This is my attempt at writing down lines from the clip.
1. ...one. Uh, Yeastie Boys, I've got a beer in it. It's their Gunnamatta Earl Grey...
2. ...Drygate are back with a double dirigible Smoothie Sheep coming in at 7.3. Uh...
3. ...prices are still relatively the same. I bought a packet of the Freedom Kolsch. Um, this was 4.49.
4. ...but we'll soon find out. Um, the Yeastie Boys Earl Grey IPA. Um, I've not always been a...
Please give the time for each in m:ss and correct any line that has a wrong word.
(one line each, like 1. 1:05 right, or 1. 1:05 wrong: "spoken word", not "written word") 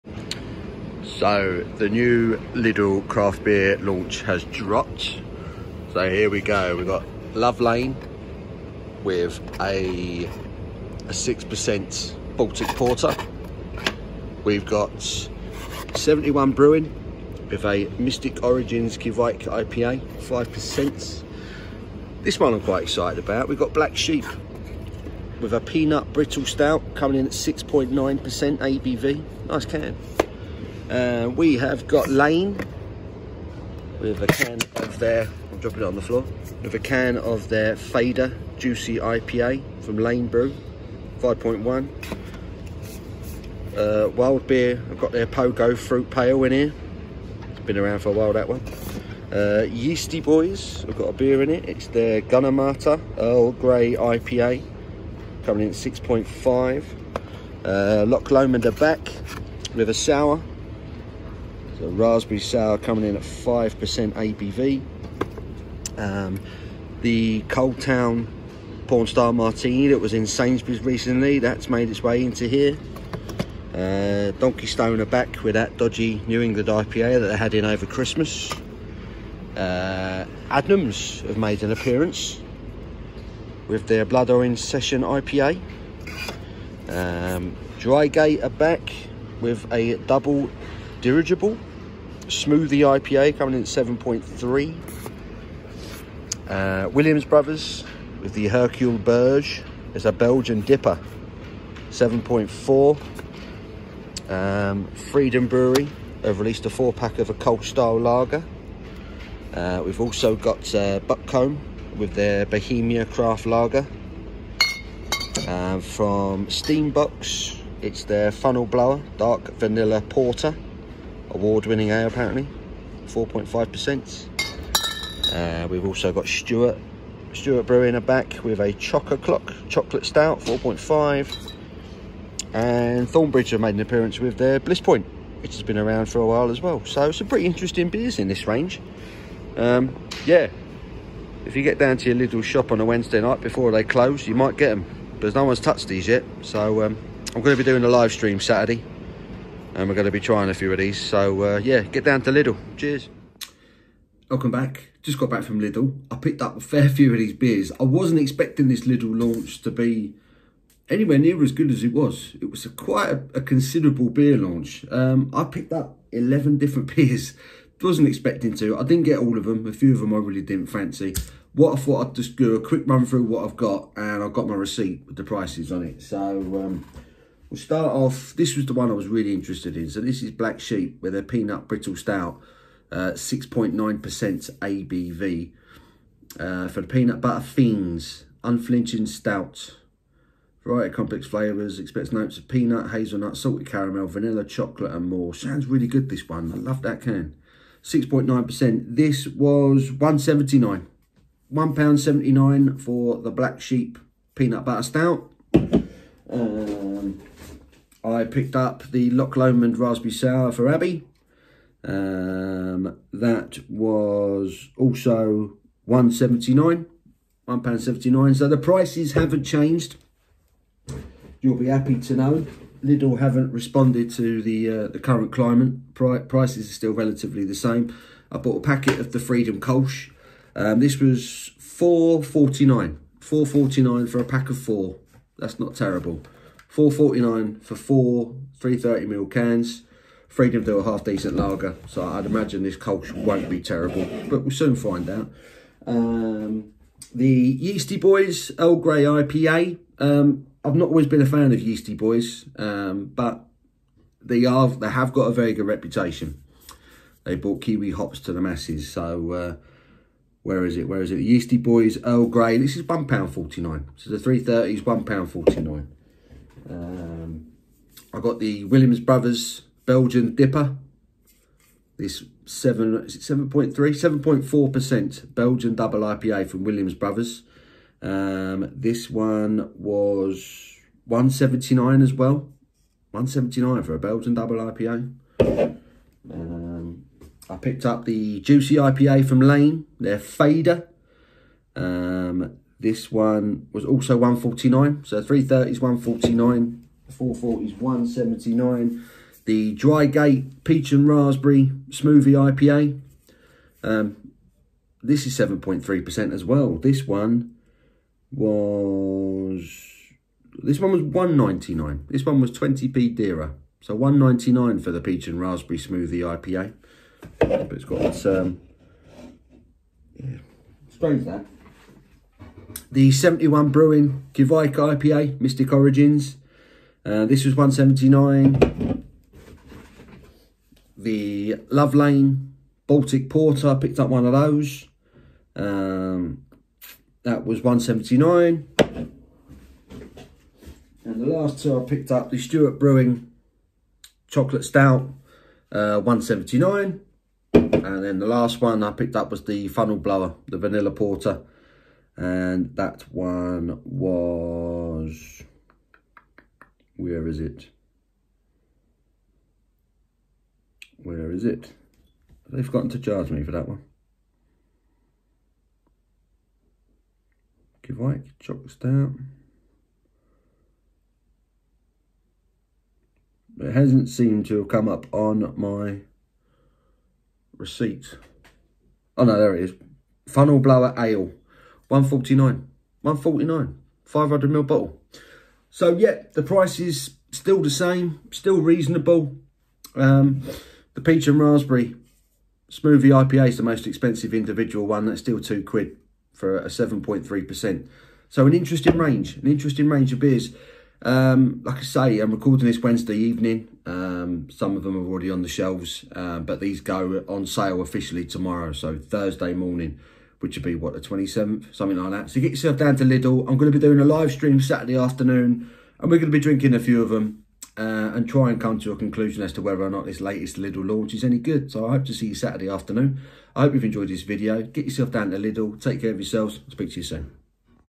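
1. 0:48 right
2. 1:27 wrong: "IPA", not "Sheep"
3. 3:46 right
4. 4:04 right.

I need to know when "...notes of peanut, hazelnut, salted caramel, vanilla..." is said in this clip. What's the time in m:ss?
3:12.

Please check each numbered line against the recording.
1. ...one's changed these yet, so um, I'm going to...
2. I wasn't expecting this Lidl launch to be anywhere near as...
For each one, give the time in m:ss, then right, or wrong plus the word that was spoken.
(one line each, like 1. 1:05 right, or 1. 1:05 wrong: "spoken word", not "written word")
1. 2:25 wrong: "touched", not "changed"
2. 2:37 right.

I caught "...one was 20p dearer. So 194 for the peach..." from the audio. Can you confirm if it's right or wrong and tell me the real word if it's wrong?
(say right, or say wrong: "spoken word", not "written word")
wrong: "199", not "194".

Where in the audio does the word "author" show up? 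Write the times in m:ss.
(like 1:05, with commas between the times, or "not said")
not said.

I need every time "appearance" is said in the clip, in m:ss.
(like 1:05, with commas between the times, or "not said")
1:21, 2:13.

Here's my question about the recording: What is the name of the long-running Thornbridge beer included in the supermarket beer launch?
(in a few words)
Bliss Point.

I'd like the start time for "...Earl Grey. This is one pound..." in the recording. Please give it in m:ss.
4:22.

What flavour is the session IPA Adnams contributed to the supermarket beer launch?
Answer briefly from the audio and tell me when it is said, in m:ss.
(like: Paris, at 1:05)
Blood Orange, at 1:24.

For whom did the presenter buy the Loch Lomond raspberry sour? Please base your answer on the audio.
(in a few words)
Abby.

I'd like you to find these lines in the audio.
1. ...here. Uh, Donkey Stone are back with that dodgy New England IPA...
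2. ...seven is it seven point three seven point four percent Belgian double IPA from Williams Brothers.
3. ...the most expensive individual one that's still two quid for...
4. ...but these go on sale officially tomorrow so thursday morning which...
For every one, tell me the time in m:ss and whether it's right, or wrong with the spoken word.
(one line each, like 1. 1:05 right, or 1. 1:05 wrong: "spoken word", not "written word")
1. 1:12 right
2. 4:32 right
3. 6:33 right
4. 6:46 right.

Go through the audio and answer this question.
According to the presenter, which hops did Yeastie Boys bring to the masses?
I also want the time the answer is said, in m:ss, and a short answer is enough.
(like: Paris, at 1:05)
kiwi hops, at 4:17.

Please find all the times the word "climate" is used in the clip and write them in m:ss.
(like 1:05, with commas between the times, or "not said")
3:45.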